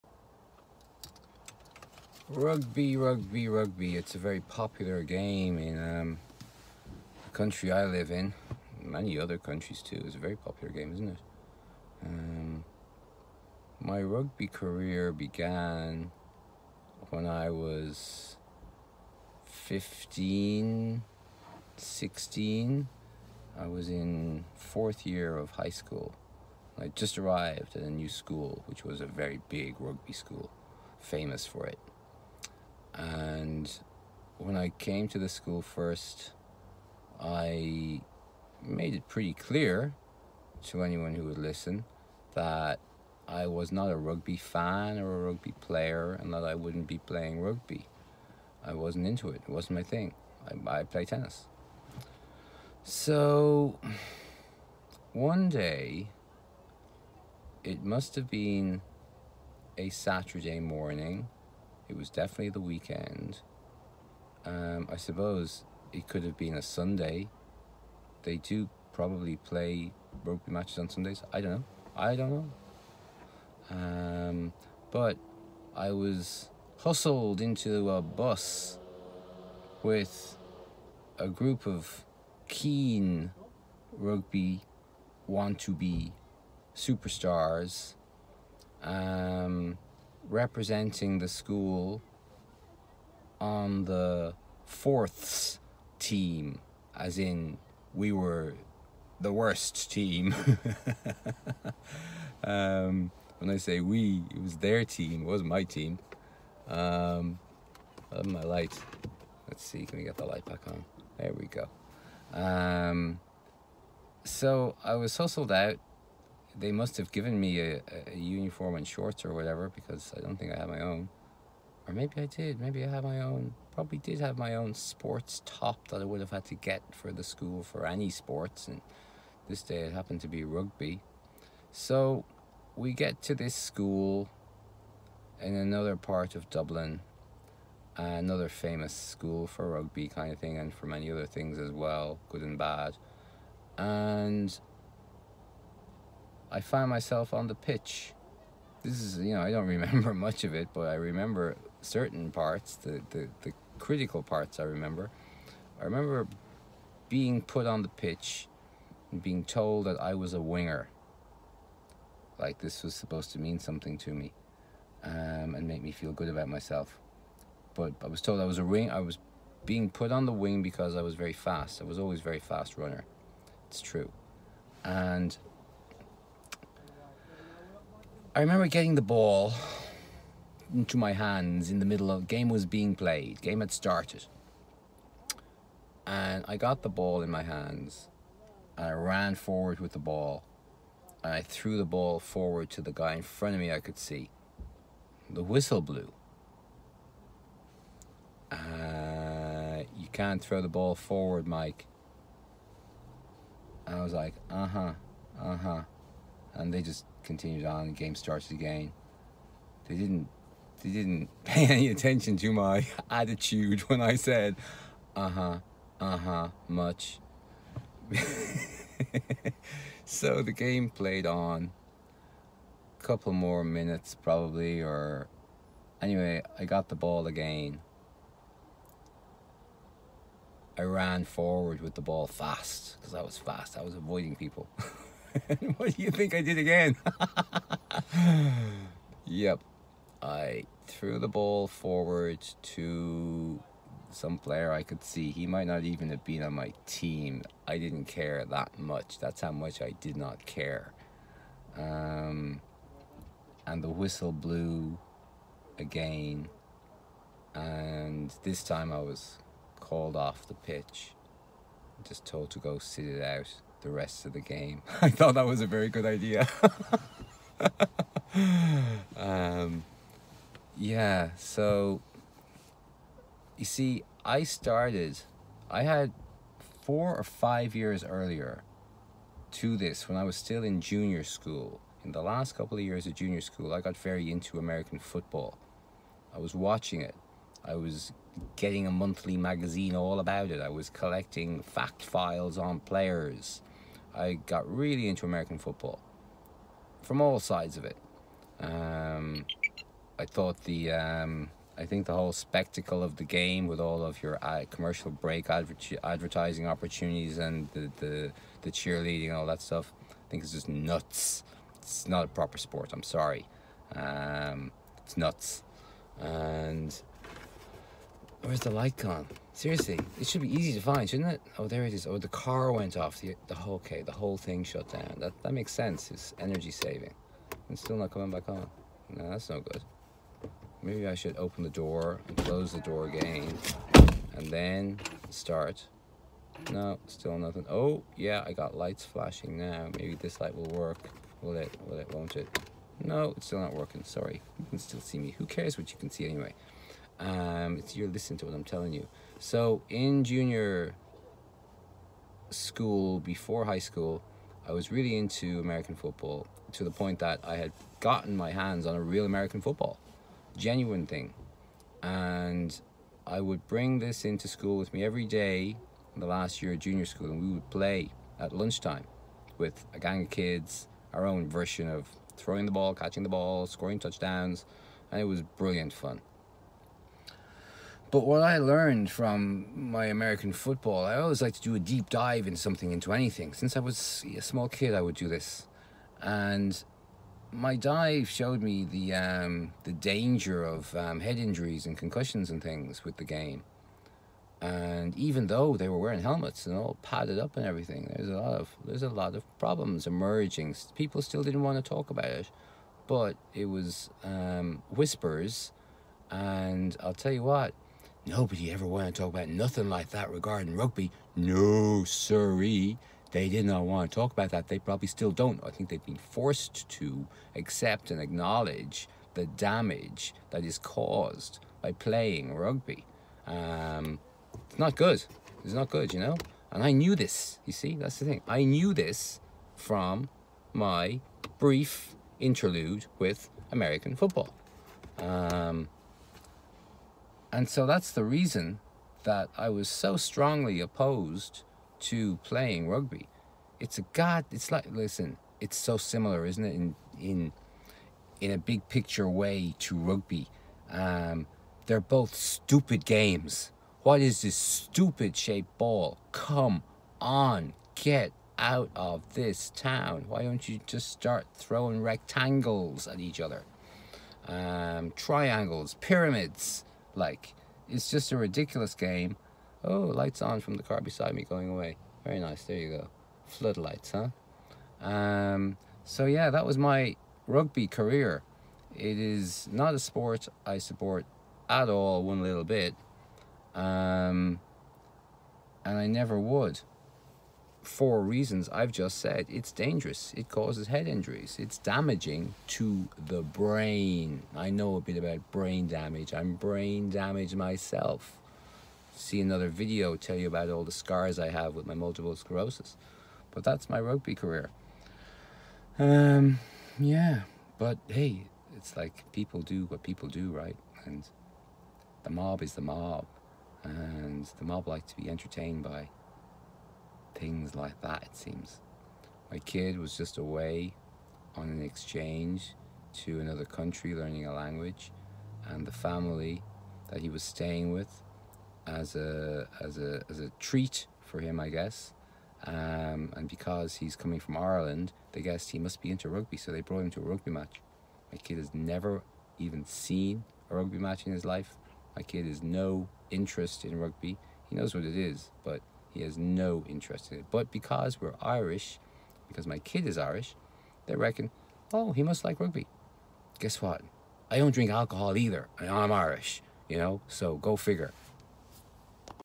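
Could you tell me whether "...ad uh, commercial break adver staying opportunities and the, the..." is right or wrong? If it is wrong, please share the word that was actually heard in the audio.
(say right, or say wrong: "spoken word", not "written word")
wrong: "advertising", not "staying".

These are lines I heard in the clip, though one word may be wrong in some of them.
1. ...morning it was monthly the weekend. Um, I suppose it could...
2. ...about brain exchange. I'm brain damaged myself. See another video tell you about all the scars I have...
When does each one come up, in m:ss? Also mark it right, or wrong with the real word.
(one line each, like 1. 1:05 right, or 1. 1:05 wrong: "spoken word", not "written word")
1. 1:00 wrong: "definitely", not "monthly"
2. 8:15 wrong: "damage", not "exchange".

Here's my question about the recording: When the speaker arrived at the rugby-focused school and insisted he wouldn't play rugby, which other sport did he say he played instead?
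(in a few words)
tennis.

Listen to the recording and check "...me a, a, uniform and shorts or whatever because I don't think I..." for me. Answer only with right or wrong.
right.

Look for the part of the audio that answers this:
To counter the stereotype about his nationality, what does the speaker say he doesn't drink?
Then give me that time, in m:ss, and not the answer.
9:14.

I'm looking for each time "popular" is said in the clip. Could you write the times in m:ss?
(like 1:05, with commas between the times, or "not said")
0:04, 0:10.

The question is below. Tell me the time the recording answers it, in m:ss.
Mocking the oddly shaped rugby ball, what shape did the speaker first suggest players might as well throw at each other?
7:42.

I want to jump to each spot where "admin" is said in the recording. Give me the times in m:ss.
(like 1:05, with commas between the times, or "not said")
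not said.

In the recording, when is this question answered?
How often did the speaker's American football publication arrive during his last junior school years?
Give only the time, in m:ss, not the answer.
4:48.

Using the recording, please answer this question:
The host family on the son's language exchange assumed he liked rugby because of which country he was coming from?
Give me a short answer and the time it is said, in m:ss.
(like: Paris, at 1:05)
Ireland, at 8:54.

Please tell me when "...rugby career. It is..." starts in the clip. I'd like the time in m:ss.
7:57.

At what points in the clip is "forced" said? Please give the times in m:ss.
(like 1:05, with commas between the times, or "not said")
6:56.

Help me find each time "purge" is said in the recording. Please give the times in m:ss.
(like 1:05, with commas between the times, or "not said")
not said.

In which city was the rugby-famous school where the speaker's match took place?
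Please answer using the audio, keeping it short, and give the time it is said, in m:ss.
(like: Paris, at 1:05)
Dublin, at 2:16.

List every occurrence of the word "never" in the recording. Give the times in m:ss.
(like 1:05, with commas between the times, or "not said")
8:06, 8:58.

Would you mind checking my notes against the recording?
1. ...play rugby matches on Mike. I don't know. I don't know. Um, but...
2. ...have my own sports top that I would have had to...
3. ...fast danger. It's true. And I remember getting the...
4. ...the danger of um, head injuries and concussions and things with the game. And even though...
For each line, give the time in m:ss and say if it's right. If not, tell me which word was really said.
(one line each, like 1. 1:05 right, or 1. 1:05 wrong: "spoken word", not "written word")
1. 1:09 wrong: "Sundays", not "Mike"
2. 2:04 right
3. 2:52 wrong: "runner", not "danger"
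4. 6:29 right.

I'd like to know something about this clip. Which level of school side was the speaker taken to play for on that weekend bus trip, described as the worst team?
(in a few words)
fourths team.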